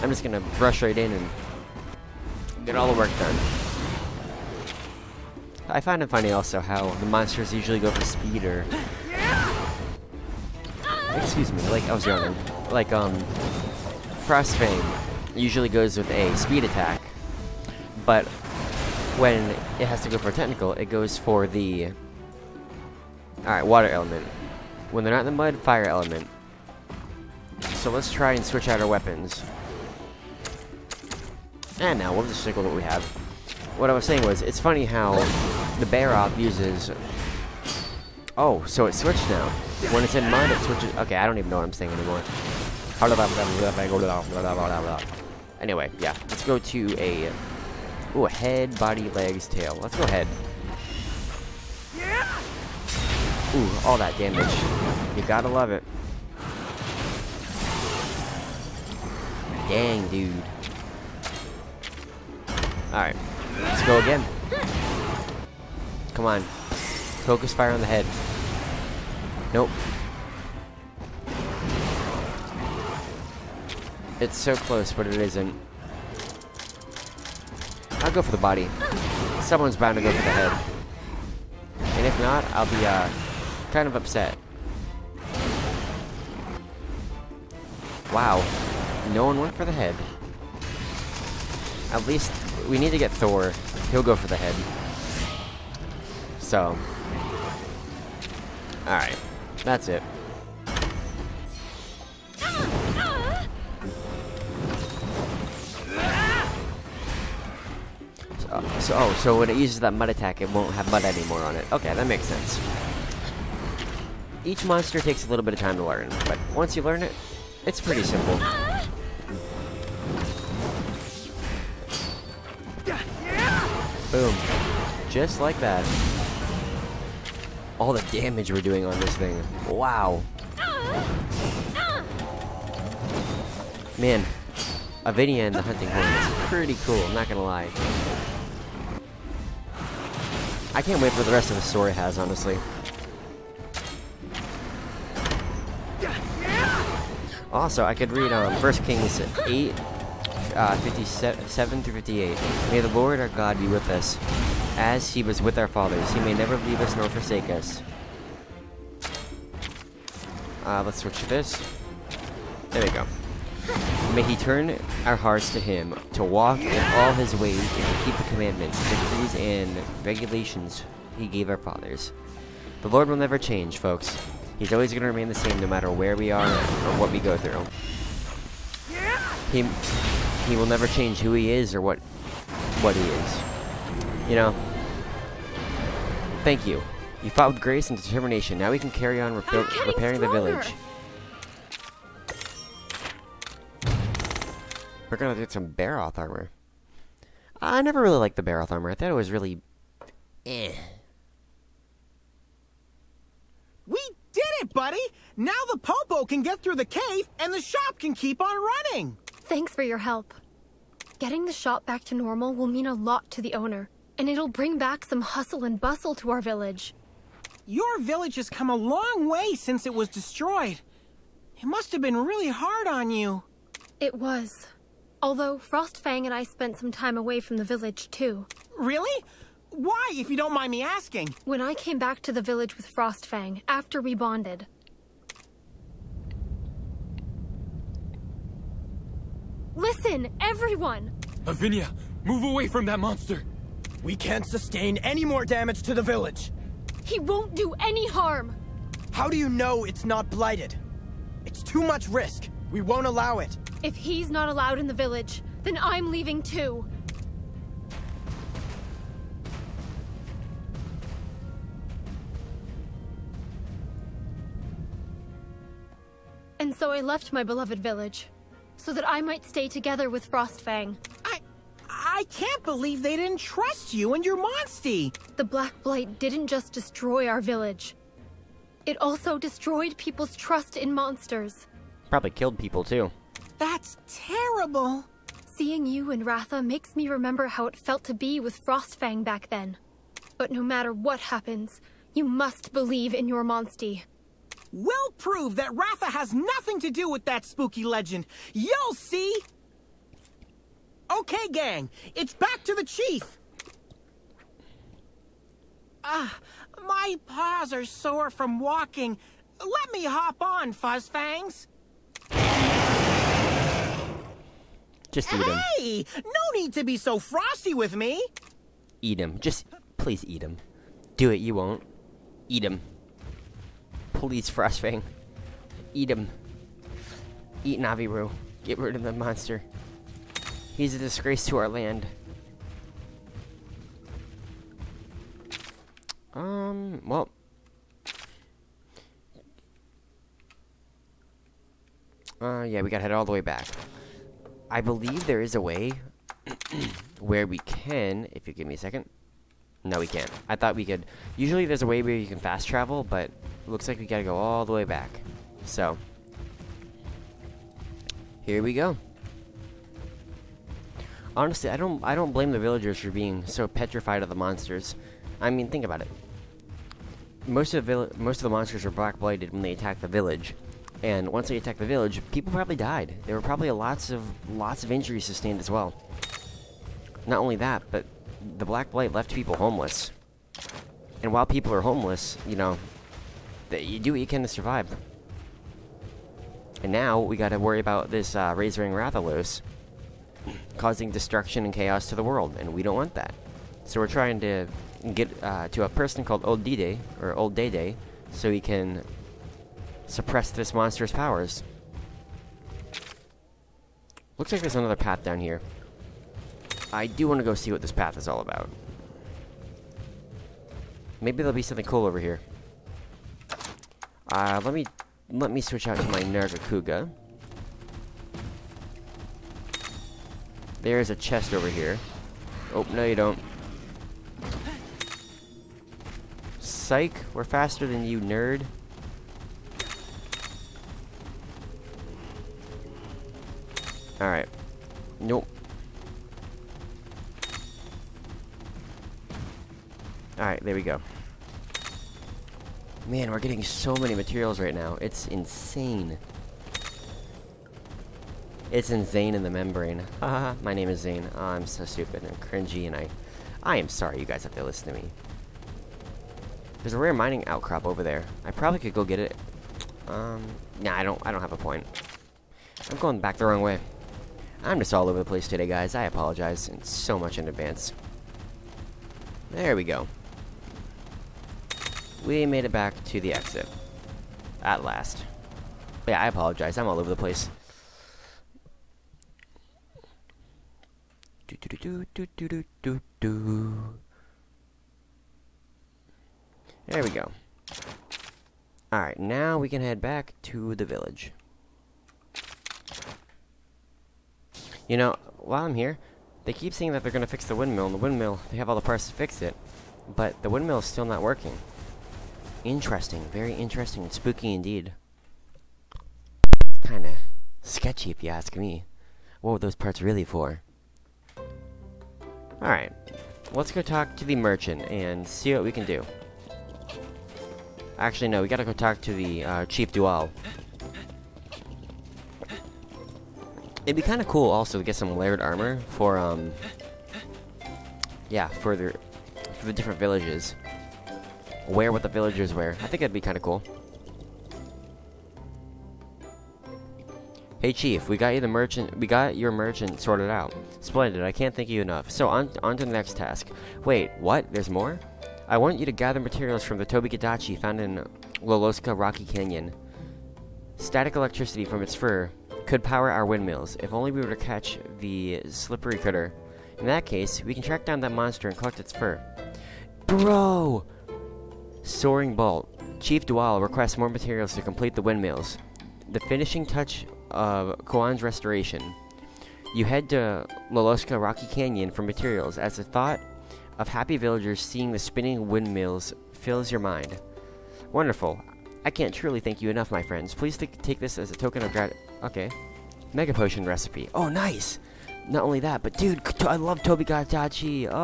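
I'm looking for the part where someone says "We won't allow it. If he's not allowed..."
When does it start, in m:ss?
4:12.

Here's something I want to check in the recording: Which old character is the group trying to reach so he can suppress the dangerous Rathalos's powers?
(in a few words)
Old Dede.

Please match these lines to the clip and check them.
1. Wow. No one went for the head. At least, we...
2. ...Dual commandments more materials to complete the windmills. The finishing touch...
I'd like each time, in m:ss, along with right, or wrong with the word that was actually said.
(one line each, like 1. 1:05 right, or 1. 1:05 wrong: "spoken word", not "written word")
1. 1:28 right
2. 9:23 wrong: "requests", not "commandments".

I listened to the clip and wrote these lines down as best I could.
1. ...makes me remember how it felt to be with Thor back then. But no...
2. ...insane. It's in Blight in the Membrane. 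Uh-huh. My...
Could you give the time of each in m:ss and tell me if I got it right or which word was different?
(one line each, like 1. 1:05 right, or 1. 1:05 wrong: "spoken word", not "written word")
1. 4:46 wrong: "Frostfang", not "Thor"
2. 7:25 wrong: "Zane", not "Blight".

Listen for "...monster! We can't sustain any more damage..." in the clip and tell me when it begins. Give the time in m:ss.
4:02.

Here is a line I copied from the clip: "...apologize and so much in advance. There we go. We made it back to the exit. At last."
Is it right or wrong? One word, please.
right.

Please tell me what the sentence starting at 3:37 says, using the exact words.
Your village has come a long way since it was destroyed.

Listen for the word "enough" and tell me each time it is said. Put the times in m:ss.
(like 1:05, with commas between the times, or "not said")
9:01, 9:39.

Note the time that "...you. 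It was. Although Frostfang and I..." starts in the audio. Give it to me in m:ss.
3:43.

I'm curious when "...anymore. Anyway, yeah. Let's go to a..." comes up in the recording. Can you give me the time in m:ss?
0:41.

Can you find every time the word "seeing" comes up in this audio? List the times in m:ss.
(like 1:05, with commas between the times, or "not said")
4:45, 9:34.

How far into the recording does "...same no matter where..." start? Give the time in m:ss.
2:55.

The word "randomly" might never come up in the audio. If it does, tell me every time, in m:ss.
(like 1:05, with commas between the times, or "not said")
not said.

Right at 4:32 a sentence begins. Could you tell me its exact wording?
I can't believe they didn't trust you and your Monstie!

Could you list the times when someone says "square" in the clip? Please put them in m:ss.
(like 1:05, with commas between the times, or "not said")
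not said.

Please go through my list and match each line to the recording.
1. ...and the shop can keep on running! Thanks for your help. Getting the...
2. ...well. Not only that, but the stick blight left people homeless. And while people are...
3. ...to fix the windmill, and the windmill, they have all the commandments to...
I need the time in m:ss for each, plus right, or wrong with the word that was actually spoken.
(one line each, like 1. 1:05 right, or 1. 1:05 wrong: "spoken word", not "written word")
1. 3:27 right
2. 6:15 wrong: "black", not "stick"
3. 8:17 wrong: "parts", not "commandments".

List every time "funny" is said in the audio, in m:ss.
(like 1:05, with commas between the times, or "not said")
0:06, 0:34.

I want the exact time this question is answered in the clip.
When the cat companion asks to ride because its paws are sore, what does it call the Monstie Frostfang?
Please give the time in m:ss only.
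5:10.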